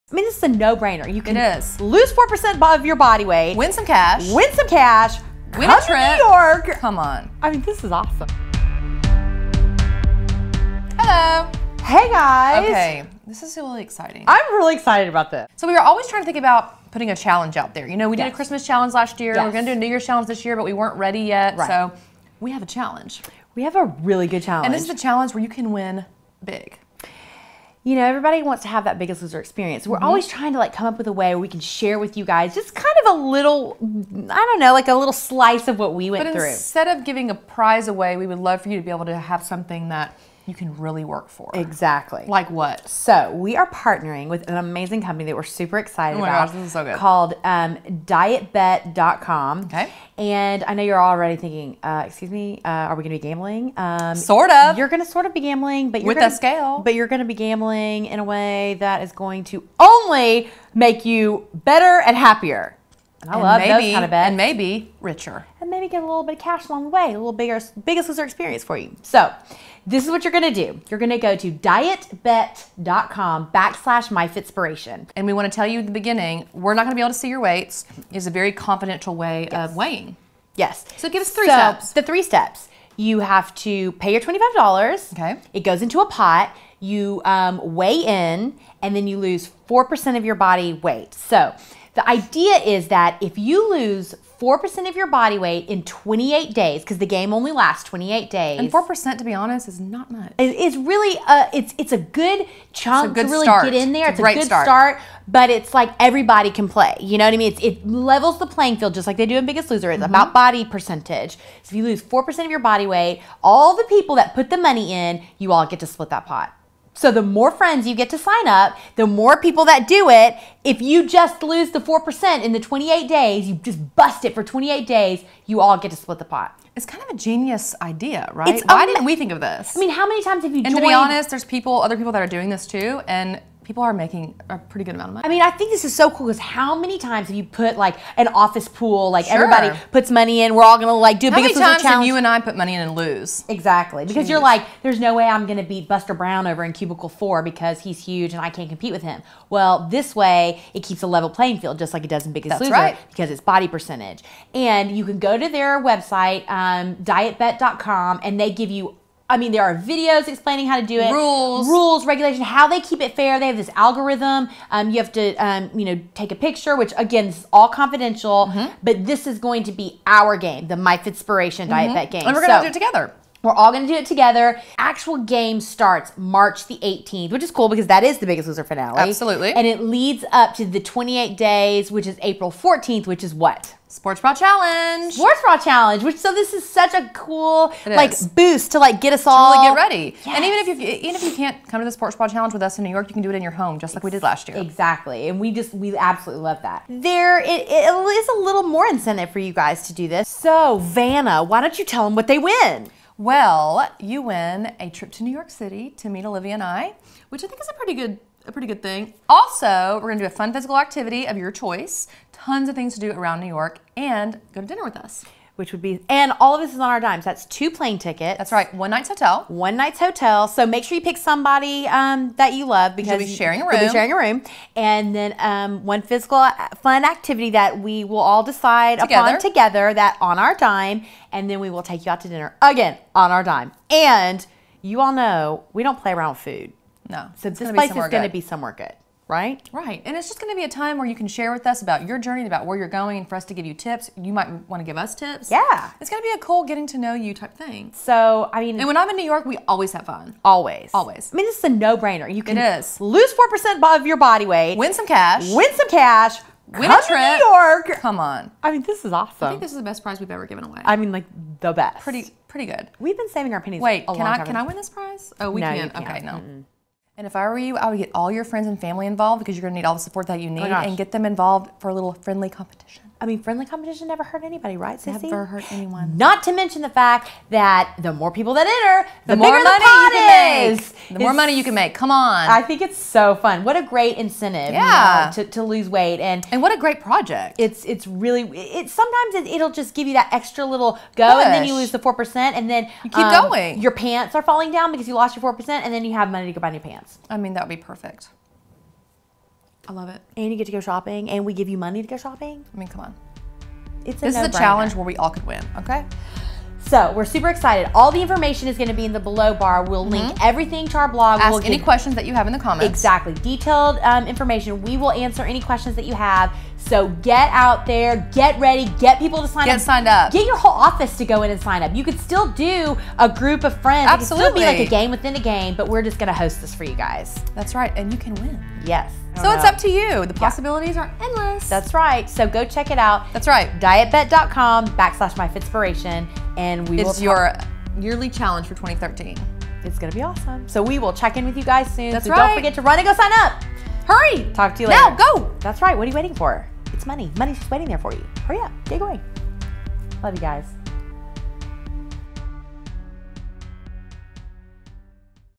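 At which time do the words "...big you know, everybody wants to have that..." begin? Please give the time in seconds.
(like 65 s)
26 s.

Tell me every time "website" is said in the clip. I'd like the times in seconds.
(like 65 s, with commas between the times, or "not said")
155 s.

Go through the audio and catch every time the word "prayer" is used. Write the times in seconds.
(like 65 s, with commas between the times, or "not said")
not said.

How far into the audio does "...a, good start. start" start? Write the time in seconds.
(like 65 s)
104 s.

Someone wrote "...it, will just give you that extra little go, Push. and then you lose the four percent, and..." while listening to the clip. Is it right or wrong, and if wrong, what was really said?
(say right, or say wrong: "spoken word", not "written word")
right.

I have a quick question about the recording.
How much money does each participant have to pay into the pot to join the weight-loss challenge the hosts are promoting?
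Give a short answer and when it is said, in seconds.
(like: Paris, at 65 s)
$25, at 84 s.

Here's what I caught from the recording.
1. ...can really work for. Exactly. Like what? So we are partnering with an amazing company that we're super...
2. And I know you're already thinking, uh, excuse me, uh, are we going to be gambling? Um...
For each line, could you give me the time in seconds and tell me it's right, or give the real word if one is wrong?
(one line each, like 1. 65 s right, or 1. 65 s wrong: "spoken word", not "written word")
1. 40 s right
2. 50 s right.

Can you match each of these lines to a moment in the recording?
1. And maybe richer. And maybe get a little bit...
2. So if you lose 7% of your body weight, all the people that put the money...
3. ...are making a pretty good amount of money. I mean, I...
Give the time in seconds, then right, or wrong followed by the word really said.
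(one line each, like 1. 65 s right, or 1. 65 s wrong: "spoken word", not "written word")
1. 64 s right
2. 111 s wrong: "4", not "7"
3. 133 s right.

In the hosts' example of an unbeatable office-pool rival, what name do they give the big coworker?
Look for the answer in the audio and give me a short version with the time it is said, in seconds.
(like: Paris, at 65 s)
Buster Brown, at 145 s.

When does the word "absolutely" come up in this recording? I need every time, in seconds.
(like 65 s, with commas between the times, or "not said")
178 s, 195 s, 324 s.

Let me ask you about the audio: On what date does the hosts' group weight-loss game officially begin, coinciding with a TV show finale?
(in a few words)
March 18th.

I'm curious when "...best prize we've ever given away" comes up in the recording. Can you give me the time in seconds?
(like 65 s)
259 s.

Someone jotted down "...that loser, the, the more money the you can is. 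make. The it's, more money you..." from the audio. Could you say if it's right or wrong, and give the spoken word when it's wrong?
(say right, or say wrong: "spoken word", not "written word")
wrong: "enter", not "loser".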